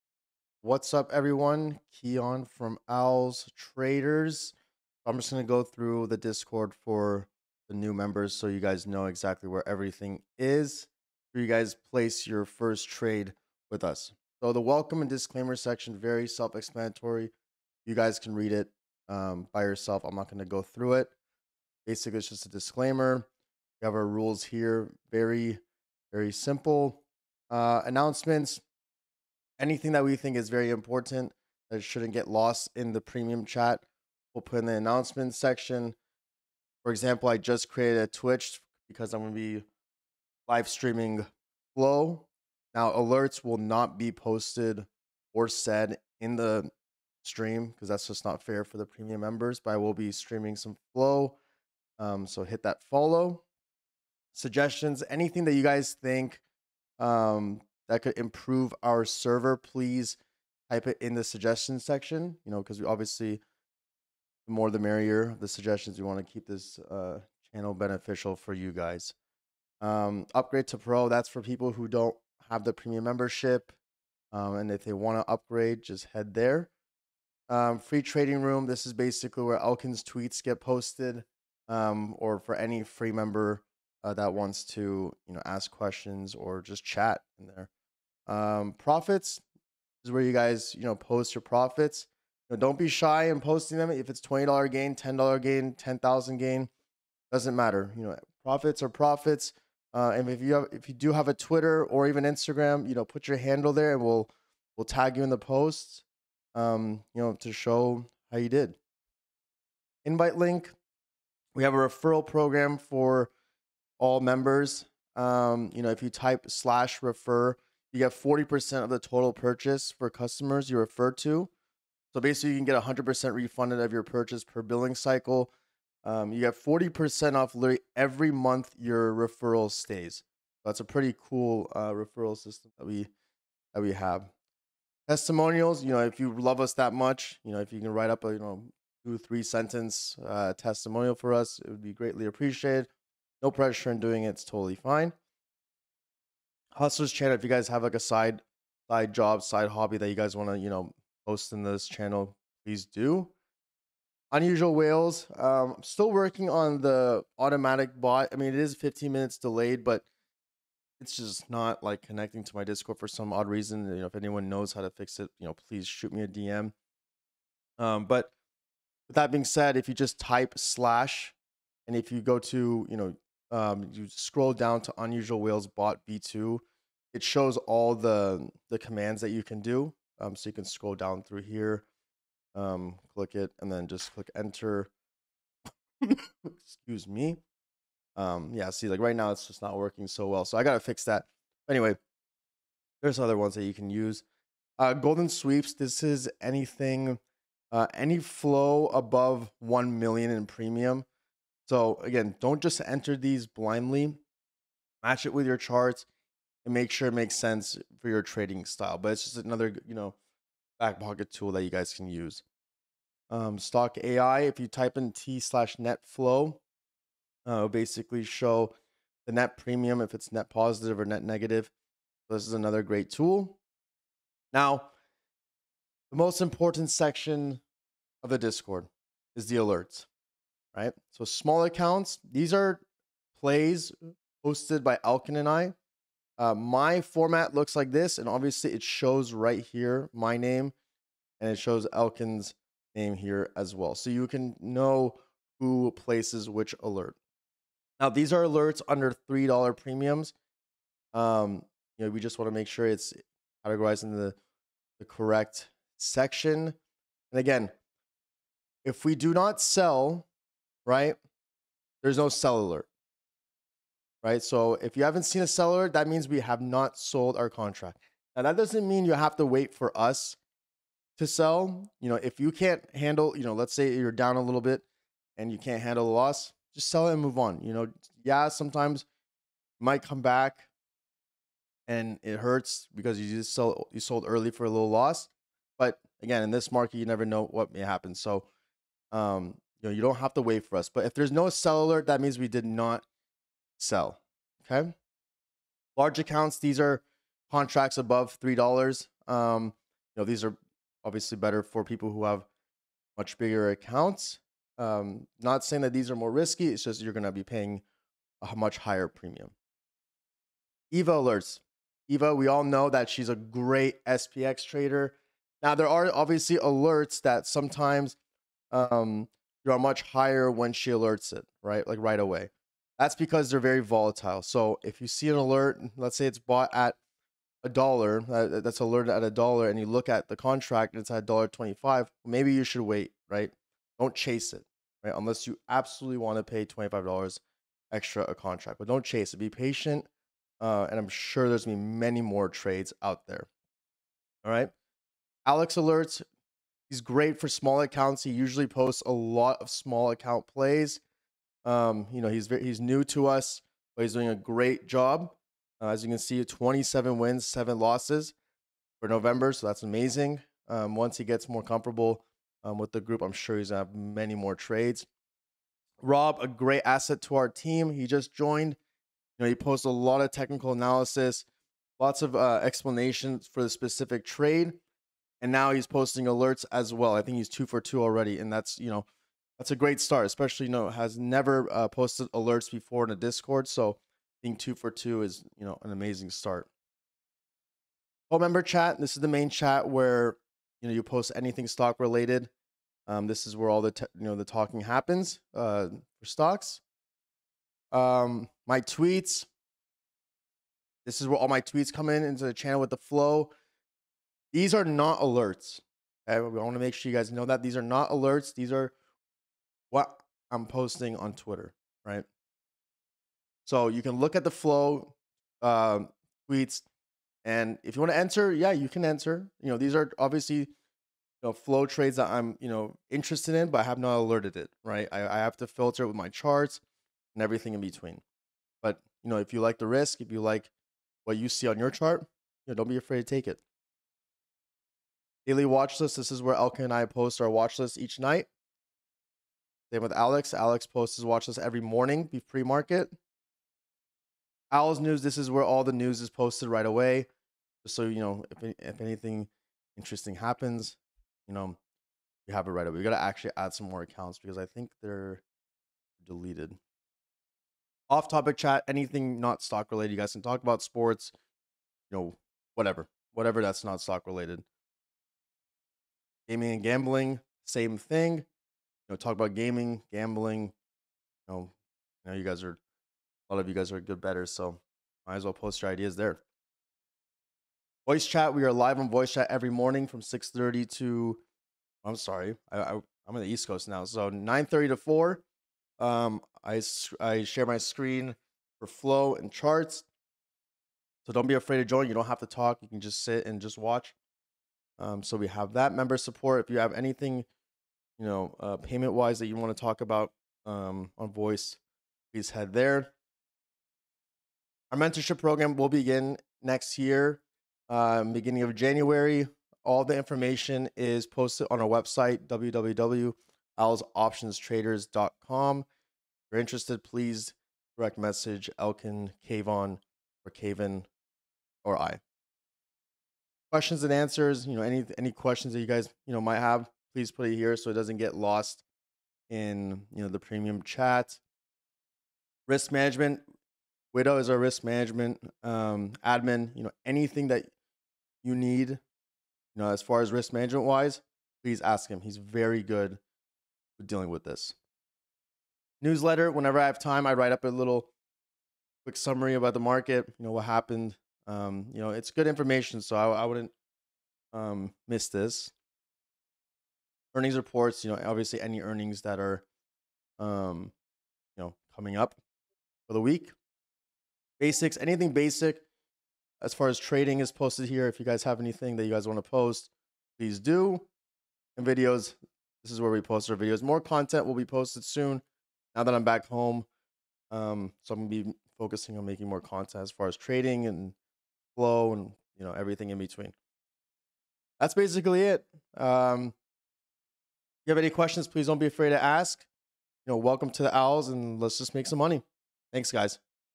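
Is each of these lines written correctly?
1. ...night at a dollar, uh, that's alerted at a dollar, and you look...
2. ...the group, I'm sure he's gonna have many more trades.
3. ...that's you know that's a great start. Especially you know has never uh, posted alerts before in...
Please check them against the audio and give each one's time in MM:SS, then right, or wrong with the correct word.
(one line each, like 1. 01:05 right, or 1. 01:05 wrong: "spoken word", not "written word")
1. 05:26 wrong: "bought", not "night"
2. 06:02 right
3. 06:18 right.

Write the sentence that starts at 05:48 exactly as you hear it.
He usually posts a lot of small account plays.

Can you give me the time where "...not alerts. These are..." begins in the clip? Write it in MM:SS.
06:47.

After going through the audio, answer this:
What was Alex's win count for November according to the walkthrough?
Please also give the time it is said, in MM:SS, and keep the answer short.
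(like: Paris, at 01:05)
27, at 05:56.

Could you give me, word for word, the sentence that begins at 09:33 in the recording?
More content will be posted soon now that I'm back home.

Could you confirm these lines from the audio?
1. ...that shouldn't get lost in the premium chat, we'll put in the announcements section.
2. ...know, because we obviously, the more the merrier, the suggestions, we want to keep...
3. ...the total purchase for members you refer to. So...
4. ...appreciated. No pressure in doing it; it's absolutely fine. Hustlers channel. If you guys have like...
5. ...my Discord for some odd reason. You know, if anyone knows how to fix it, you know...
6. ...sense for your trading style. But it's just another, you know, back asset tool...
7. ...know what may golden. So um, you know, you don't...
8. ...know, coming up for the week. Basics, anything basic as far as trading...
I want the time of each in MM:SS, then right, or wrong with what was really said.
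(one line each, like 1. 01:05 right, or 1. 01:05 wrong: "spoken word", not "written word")
1. 00:31 right
2. 01:02 right
3. 01:58 wrong: "customers", not "members"
4. 02:22 wrong: "totally", not "absolutely"
5. 02:42 right
6. 03:27 wrong: "pocket", not "asset"
7. 04:47 wrong: "happen", not "golden"
8. 09:21 right.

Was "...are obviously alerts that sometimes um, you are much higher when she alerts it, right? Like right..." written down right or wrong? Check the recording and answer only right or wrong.
right.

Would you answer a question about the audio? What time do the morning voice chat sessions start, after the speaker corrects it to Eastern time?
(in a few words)
9:30.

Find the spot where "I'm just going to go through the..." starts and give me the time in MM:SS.
00:05.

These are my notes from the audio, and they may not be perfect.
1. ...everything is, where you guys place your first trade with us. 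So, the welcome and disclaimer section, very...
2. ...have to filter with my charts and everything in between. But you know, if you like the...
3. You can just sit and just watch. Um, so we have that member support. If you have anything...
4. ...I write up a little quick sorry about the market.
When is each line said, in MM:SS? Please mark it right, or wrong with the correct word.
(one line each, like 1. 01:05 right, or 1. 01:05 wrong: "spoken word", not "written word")
1. 00:09 right
2. 07:05 right
3. 08:12 right
4. 09:07 wrong: "summary", not "sorry".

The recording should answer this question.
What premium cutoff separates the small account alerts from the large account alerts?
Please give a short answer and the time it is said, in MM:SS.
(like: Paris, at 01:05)
$3, at 04:09.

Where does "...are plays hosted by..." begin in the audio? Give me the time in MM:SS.
03:52.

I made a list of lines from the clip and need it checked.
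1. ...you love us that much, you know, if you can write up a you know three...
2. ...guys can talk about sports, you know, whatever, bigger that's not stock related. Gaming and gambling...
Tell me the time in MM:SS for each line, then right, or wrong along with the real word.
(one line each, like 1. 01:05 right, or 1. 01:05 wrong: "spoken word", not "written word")
1. 02:16 wrong: "two", not "three"
2. 07:40 wrong: "whatever", not "bigger".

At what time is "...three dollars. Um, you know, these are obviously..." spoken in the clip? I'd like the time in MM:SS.
04:58.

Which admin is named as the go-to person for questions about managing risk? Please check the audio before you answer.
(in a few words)
Widow.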